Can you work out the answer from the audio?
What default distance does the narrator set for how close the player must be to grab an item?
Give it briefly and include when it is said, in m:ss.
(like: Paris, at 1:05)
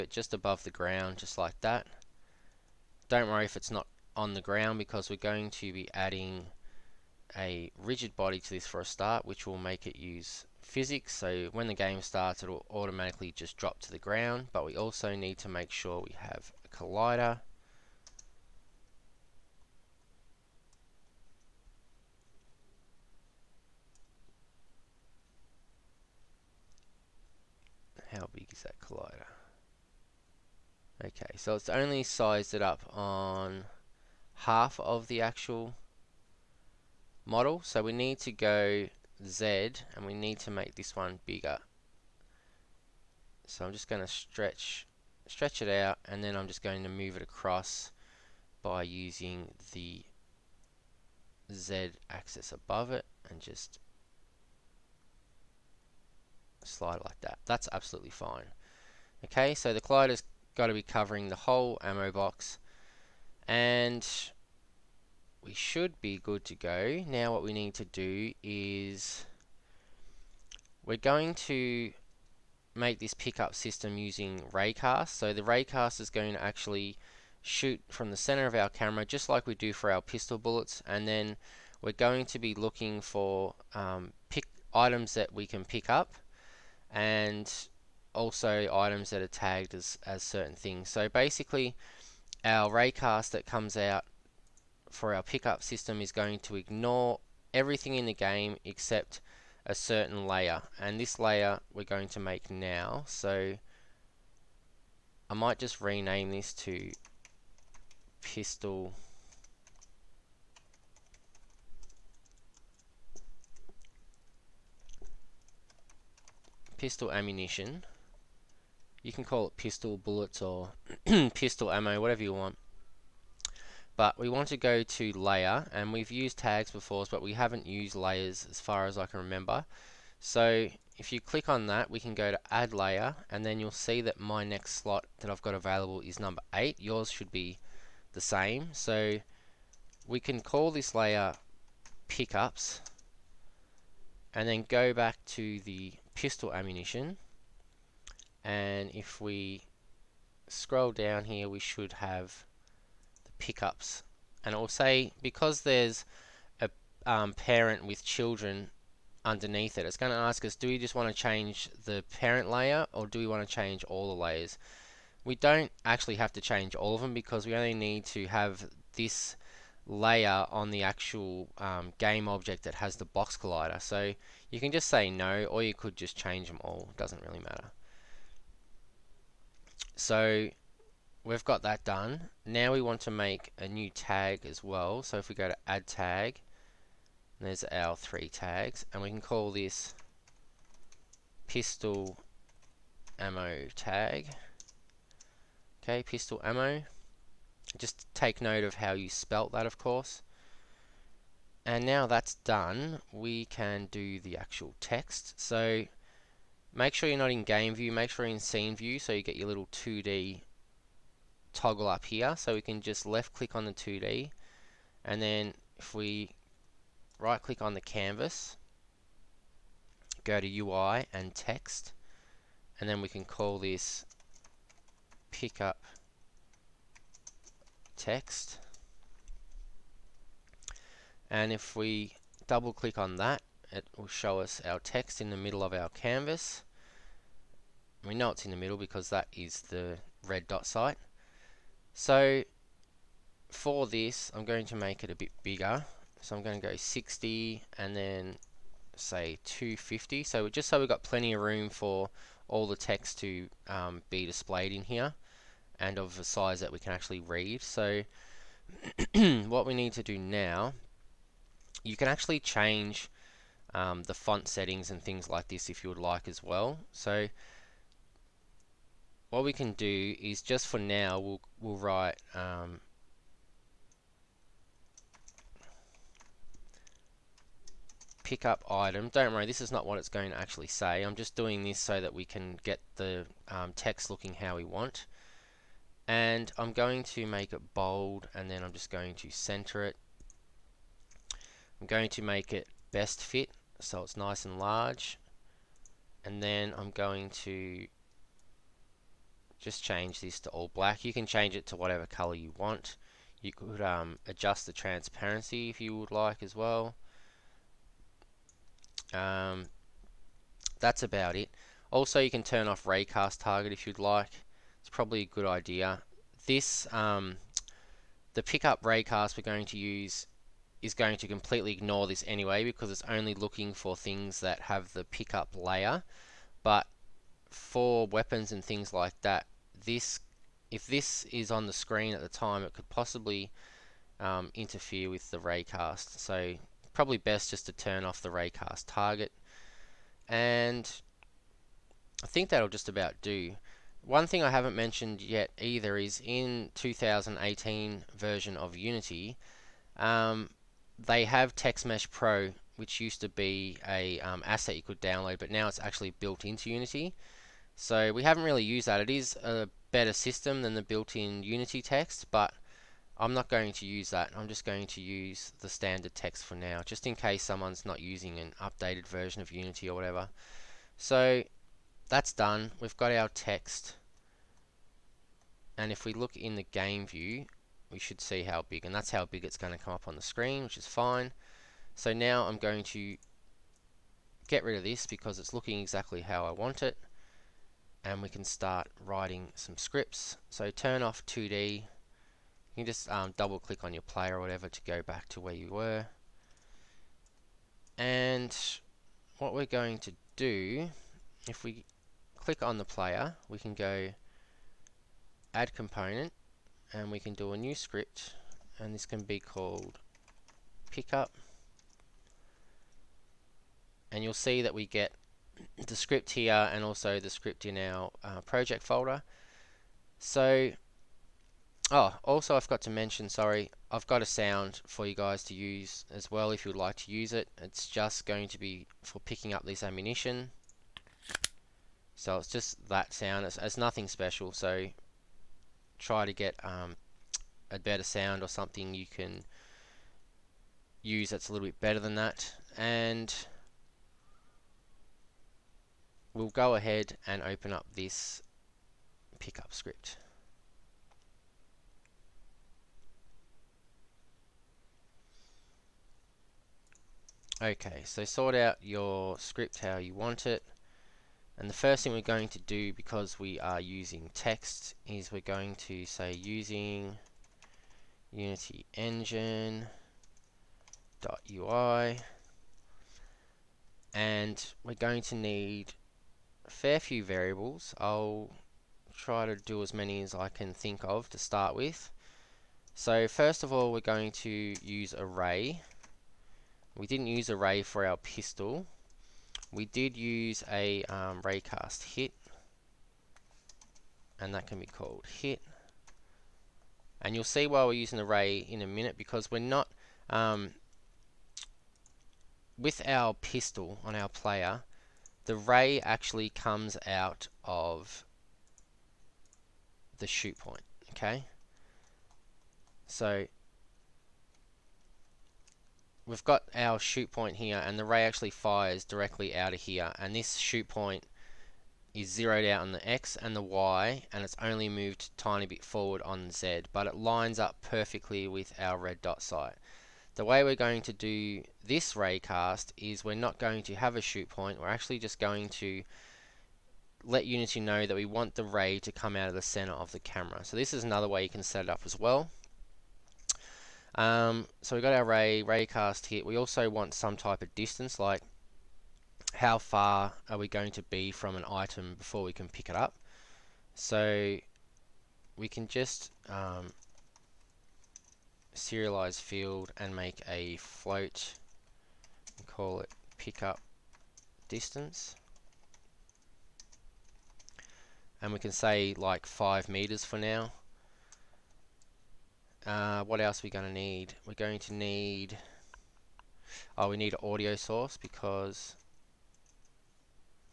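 5 meters, at 9:29.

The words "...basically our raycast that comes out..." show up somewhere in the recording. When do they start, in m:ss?
1:31.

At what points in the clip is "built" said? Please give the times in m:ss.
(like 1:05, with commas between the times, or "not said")
5:56, 6:00.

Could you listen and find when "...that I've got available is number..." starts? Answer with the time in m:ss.
2:15.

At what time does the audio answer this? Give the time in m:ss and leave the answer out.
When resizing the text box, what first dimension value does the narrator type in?
4:06.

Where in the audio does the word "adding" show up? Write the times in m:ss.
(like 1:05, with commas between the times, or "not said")
0:05.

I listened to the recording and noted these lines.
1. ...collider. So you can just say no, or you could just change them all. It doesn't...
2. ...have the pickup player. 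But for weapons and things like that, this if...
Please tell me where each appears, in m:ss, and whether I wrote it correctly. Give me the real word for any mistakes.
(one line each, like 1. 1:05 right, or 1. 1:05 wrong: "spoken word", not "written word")
1. 2:53 right
2. 5:24 wrong: "layer", not "player".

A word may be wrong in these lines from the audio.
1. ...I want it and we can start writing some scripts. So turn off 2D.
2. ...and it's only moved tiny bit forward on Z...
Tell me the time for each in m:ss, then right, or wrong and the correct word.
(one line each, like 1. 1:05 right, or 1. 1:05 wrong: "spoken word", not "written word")
1. 6:26 right
2. 8:44 right.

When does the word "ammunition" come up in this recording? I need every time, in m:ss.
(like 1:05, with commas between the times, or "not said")
1:57, 2:26, 7:09.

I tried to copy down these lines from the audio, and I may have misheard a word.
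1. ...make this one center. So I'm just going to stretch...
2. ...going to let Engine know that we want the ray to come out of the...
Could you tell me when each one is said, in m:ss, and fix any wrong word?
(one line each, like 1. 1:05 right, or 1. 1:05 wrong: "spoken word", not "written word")
1. 0:40 wrong: "bigger", not "center"
2. 8:55 wrong: "Unity", not "Engine".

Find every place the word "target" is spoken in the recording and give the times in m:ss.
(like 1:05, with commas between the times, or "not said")
5:13, 5:38.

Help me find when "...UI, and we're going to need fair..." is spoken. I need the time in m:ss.
7:51.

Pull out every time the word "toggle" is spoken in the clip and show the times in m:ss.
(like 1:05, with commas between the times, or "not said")
3:31.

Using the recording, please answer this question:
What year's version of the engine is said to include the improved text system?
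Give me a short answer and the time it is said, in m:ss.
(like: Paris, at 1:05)
2018, at 5:46.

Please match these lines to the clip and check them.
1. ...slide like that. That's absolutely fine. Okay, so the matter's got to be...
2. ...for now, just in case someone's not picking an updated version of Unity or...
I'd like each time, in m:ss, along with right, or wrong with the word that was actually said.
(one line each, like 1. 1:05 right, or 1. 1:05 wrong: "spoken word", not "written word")
1. 0:56 wrong: "collider", not "matter"
2. 6:06 wrong: "using", not "picking".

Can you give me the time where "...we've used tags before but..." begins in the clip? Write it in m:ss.
2:05.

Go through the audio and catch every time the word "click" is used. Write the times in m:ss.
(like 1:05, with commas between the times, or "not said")
2:11, 3:33, 3:37, 3:52, 6:33, 6:42.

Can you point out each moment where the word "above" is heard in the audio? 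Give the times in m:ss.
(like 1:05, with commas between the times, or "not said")
0:00, 0:52.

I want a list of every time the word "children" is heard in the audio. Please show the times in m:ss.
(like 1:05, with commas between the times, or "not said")
2:38.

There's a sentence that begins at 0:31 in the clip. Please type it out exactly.
Okay, so it's only sized it up on half of the actual model.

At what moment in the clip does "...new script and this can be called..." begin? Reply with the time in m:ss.
6:47.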